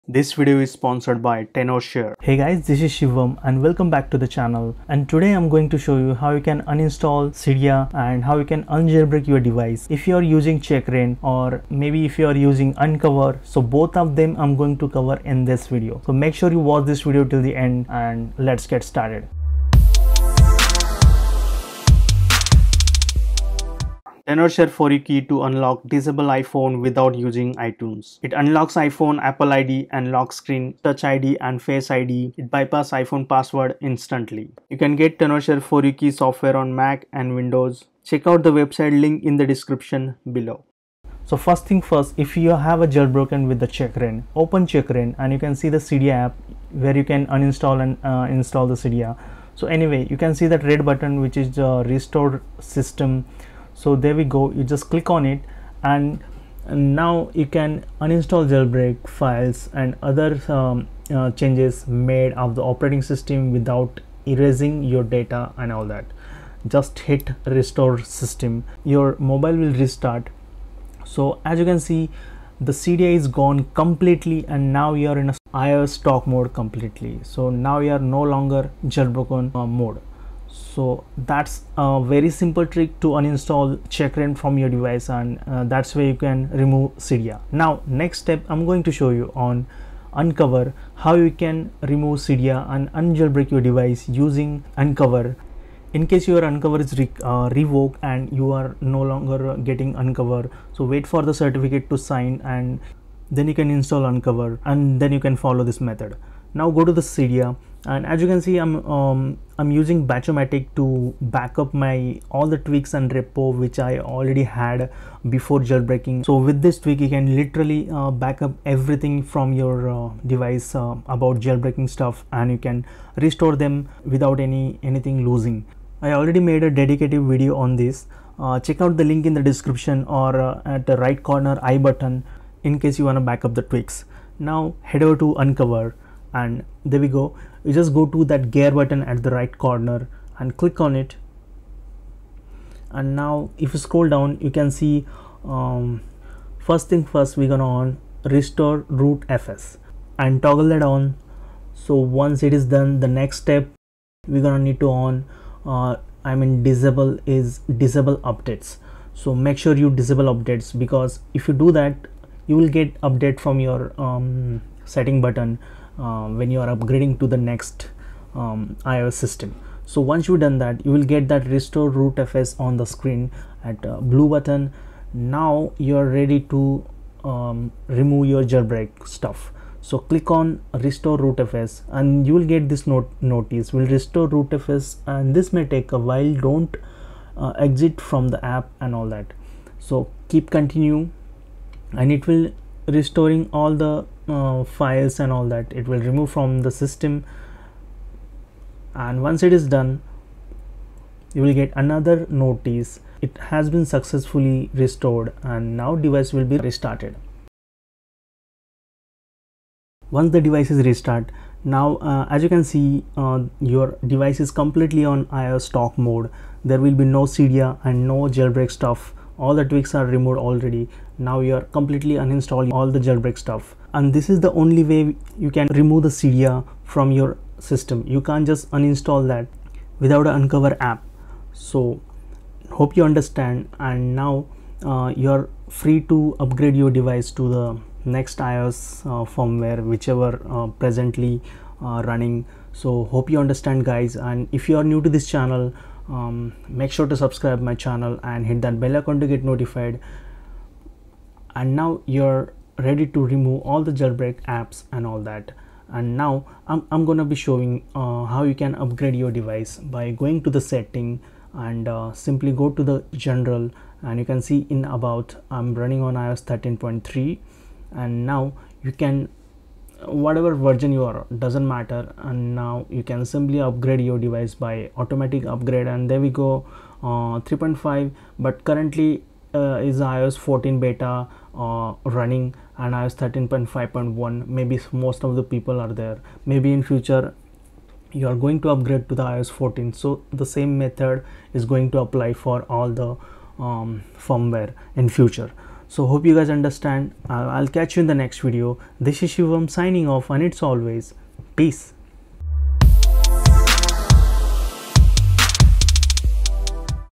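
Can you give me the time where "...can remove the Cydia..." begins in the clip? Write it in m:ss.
3:45.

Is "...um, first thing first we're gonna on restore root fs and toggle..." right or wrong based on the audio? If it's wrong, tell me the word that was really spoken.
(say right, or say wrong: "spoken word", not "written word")
right.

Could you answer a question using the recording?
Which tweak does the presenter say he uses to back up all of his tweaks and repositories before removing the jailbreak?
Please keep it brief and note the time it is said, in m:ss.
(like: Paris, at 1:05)
Batchomatic, at 1:50.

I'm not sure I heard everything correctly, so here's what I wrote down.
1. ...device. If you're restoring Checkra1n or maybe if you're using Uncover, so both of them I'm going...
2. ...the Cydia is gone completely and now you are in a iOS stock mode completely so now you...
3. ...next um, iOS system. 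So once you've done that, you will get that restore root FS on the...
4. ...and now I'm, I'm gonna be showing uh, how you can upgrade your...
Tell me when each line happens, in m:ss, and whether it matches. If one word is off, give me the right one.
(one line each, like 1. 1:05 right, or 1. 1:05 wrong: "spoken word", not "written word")
1. 0:09 wrong: "using", not "restoring"
2. 1:12 right
3. 2:47 right
4. 4:15 right.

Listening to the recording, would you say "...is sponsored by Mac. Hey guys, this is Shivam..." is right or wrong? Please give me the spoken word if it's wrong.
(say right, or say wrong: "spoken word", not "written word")
wrong: "TenorShare", not "Mac".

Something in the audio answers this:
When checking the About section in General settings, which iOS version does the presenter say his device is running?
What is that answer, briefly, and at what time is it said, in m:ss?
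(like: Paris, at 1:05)
iOS 13.3, at 4:26.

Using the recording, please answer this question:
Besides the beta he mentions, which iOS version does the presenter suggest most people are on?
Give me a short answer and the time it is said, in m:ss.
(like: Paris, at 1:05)
iOS 13.5.1, at 4:42.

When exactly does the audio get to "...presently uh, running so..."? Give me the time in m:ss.
4:00.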